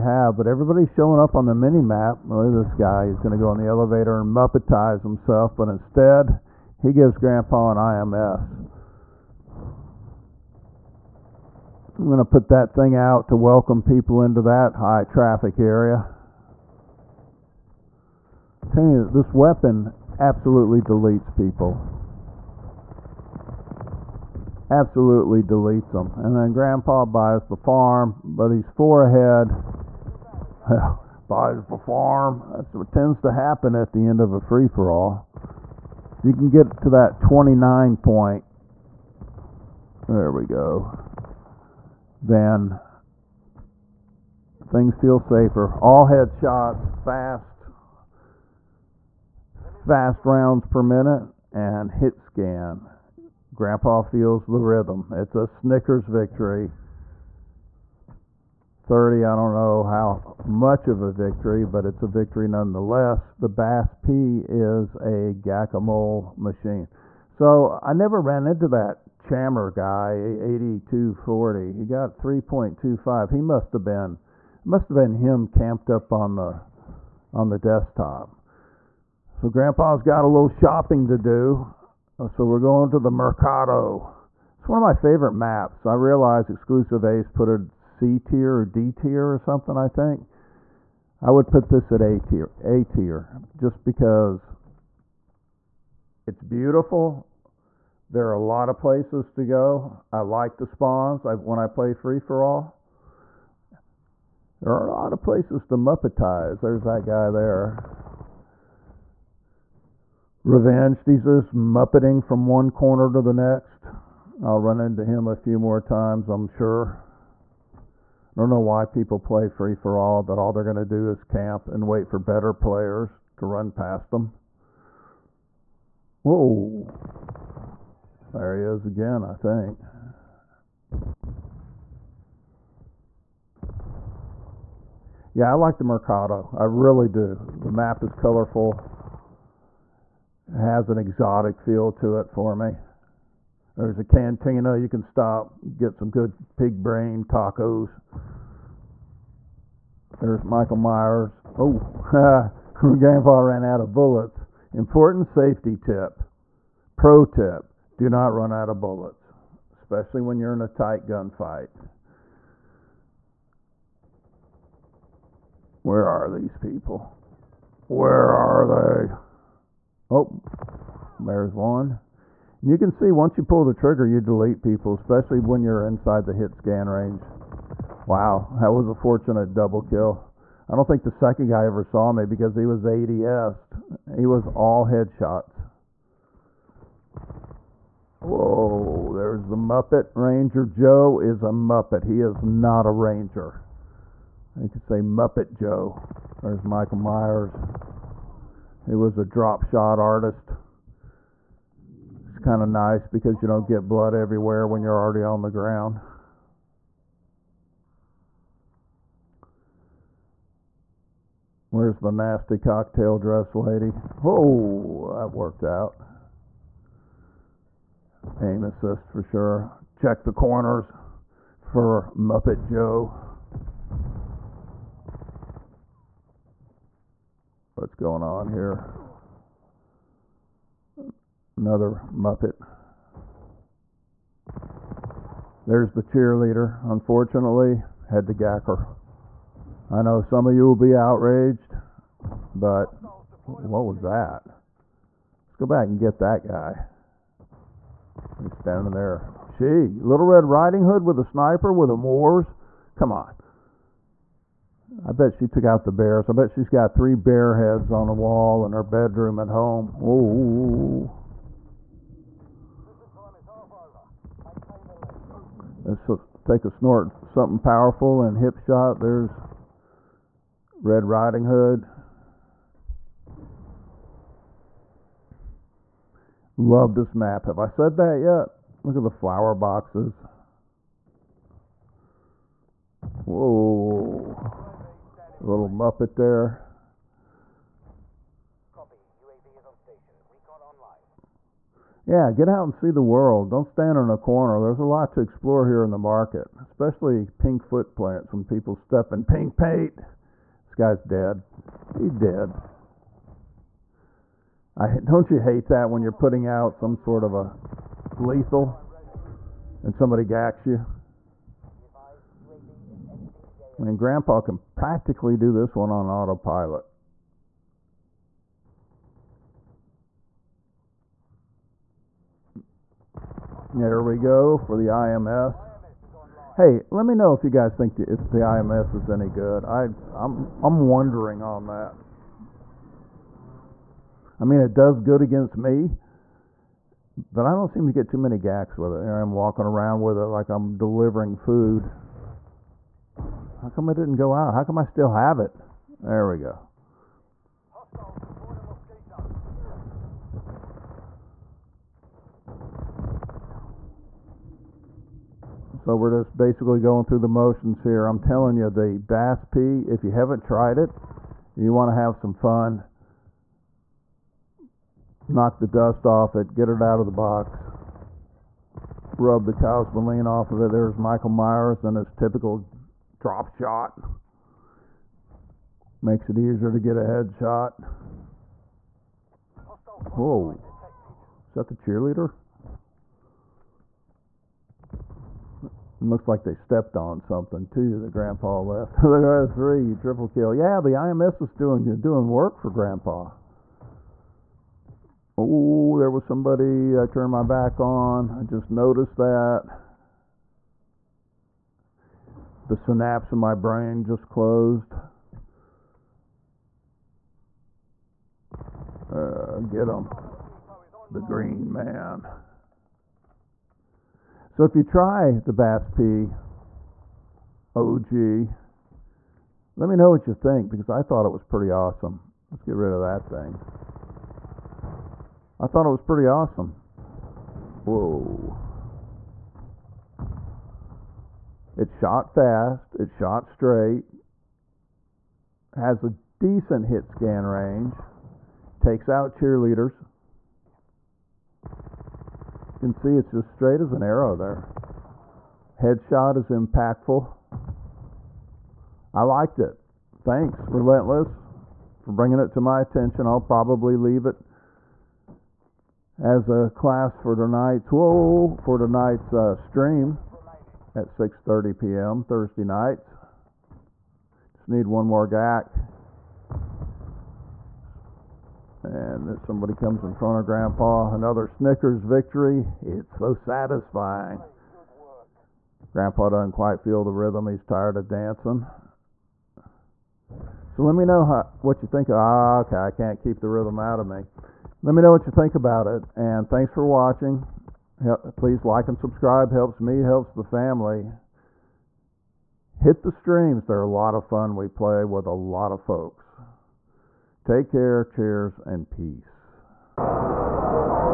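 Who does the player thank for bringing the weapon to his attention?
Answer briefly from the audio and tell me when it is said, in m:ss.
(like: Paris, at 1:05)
Relentless, at 7:30.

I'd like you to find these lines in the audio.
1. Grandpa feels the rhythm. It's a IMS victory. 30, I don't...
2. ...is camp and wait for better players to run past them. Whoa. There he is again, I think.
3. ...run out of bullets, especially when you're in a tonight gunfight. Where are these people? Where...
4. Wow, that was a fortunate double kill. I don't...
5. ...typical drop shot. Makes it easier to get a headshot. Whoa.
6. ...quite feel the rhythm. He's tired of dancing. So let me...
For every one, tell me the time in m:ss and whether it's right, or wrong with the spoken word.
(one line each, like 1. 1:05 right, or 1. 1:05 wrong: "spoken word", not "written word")
1. 0:53 wrong: "Snickers", not "IMS"
2. 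2:01 right
3. 2:38 wrong: "tight", not "tonight"
4. 2:58 right
5. 6:12 right
6. 7:56 right.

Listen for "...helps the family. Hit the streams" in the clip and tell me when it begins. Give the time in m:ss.
8:10.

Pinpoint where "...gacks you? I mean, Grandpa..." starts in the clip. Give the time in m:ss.
5:10.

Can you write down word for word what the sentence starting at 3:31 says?
Where's the nasty cocktail dress lady?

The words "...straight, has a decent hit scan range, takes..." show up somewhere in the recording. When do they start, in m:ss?
7:13.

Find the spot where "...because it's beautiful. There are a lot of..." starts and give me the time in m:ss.
1:33.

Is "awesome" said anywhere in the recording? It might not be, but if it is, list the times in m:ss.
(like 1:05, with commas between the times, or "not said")
7:01, 7:06.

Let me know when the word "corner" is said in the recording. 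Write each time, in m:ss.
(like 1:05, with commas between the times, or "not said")
1:52, 3:40, 4:54.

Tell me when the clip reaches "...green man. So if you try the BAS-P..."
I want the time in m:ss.
6:51.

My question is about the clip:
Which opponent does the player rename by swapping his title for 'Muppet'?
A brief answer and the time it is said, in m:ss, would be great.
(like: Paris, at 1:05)
Ranger Joe, at 3:10.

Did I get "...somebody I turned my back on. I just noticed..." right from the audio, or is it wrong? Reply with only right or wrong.
right.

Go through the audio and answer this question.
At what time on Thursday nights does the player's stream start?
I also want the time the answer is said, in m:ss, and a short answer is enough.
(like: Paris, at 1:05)
6:30 p.m., at 7:41.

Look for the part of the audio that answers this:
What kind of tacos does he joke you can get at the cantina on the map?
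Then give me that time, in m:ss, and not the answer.
2:26.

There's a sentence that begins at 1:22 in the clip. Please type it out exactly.
Oh, so we're going to the Mercado.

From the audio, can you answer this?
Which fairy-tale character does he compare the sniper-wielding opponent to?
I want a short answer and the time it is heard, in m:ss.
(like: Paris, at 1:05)
Little Red Riding Hood, at 4:09.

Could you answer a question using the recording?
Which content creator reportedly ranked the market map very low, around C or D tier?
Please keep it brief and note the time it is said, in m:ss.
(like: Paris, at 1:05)
Exclusive Ace, at 1:26.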